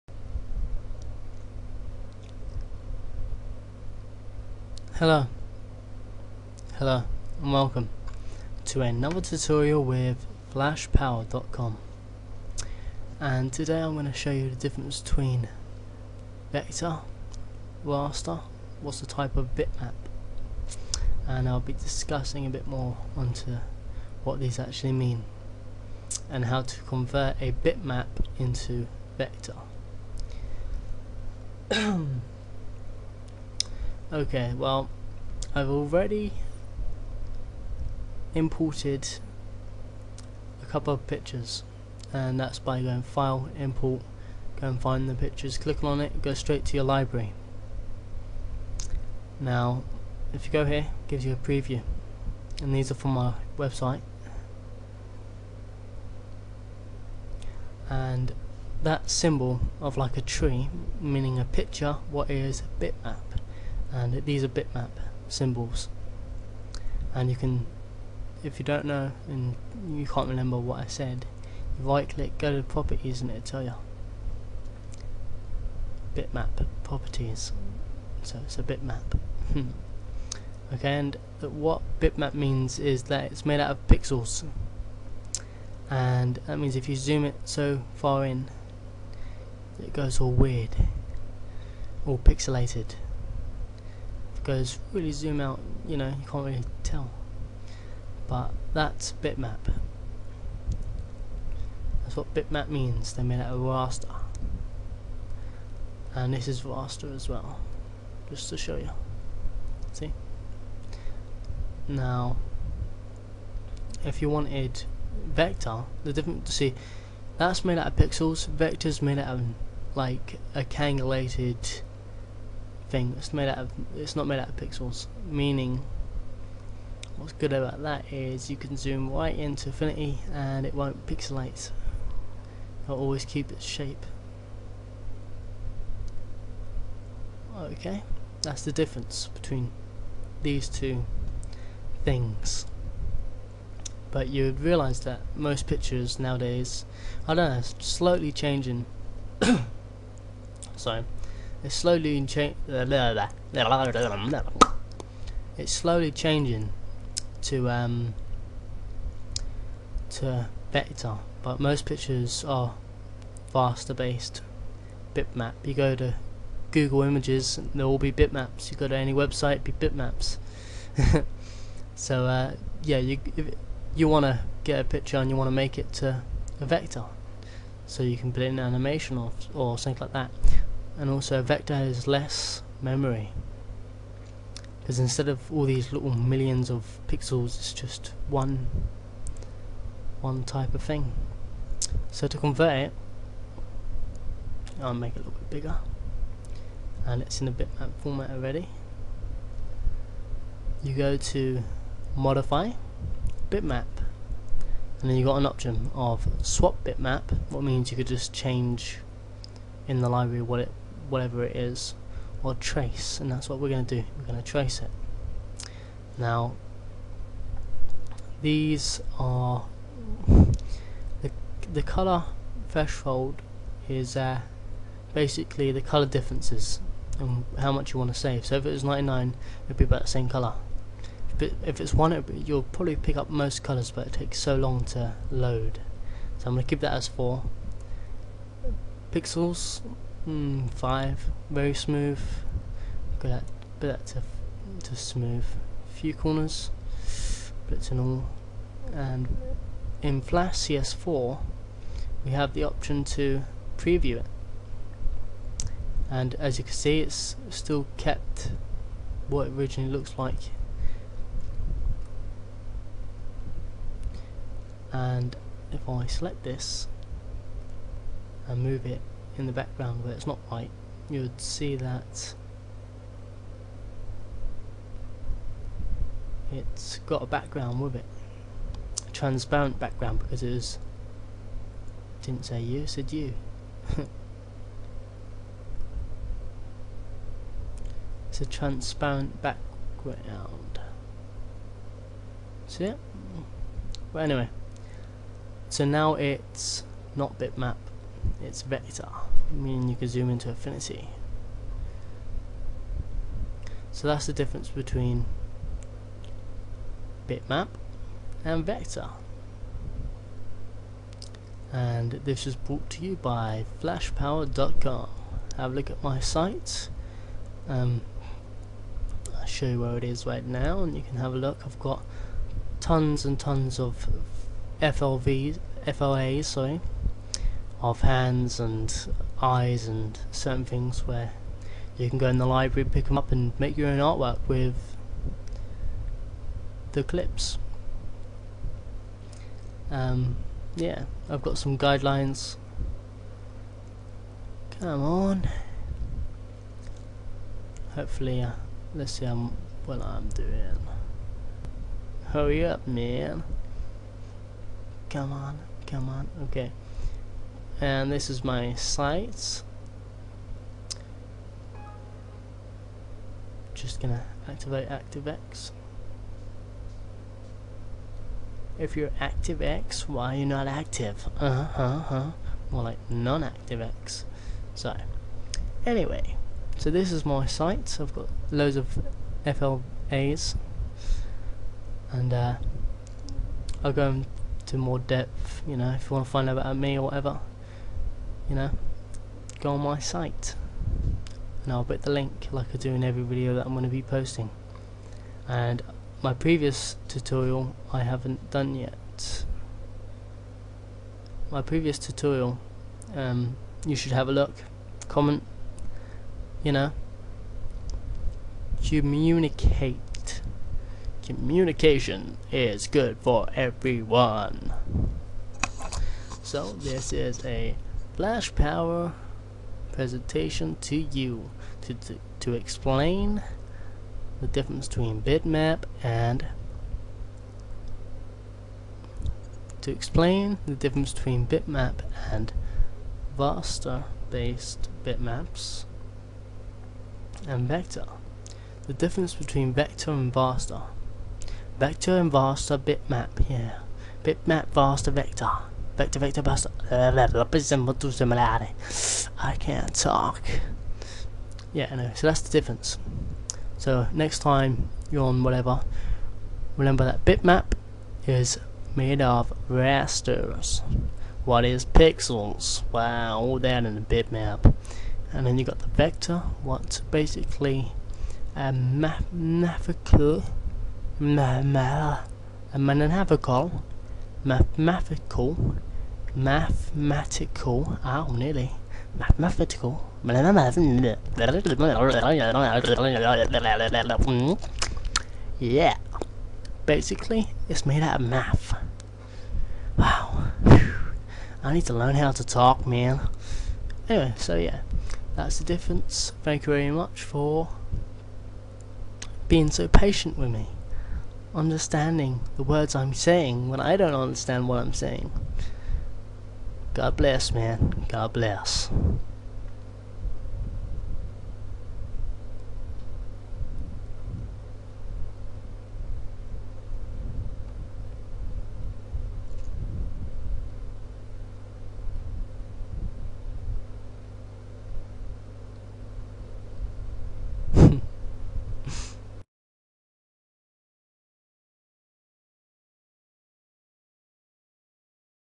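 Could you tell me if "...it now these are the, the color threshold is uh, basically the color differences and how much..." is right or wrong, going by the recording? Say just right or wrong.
right.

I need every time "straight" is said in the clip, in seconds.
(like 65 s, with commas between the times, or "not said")
46 s.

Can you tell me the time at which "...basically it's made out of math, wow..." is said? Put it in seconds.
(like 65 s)
486 s.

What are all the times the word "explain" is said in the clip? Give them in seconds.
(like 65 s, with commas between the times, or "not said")
422 s, 429 s.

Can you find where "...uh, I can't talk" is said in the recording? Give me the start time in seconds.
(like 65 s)
446 s.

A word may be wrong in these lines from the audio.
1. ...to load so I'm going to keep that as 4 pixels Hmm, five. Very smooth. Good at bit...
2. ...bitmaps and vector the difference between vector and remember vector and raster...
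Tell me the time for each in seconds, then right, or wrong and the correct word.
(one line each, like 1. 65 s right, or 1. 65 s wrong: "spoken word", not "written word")
1. 234 s right
2. 435 s wrong: "raster", not "remember".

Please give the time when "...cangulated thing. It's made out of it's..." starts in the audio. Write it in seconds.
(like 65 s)
120 s.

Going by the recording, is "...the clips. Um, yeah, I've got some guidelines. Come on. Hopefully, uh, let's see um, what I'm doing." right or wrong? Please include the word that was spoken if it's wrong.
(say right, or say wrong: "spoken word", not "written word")
right.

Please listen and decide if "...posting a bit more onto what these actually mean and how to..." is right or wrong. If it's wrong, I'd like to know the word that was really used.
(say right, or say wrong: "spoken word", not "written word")
wrong: "discussing", not "posting".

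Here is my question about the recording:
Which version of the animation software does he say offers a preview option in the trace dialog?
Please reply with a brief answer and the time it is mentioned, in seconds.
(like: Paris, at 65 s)
Flash CS4, at 250 s.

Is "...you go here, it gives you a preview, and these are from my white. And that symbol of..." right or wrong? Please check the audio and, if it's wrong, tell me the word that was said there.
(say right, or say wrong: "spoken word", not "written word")
wrong: "website", not "white".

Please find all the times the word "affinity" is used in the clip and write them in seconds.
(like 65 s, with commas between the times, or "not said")
129 s, 300 s.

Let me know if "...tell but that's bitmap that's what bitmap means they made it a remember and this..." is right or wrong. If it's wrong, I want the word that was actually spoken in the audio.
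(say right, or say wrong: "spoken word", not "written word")
wrong: "raster", not "remember".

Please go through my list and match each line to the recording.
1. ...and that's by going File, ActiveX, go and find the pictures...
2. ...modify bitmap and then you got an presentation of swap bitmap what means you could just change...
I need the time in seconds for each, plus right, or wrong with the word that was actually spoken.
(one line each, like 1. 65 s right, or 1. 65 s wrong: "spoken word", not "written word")
1. 42 s wrong: "Import", not "ActiveX"
2. 202 s wrong: "option", not "presentation".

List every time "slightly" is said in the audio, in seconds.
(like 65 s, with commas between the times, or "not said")
147 s.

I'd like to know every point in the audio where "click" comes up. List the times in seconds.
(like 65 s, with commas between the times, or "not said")
45 s, 72 s.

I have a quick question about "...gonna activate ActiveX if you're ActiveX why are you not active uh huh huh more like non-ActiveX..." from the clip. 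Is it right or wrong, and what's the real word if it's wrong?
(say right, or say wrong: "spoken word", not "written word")
right.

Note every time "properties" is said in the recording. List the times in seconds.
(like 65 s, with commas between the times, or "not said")
72 s, 76 s.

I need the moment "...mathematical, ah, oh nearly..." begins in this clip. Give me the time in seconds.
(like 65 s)
476 s.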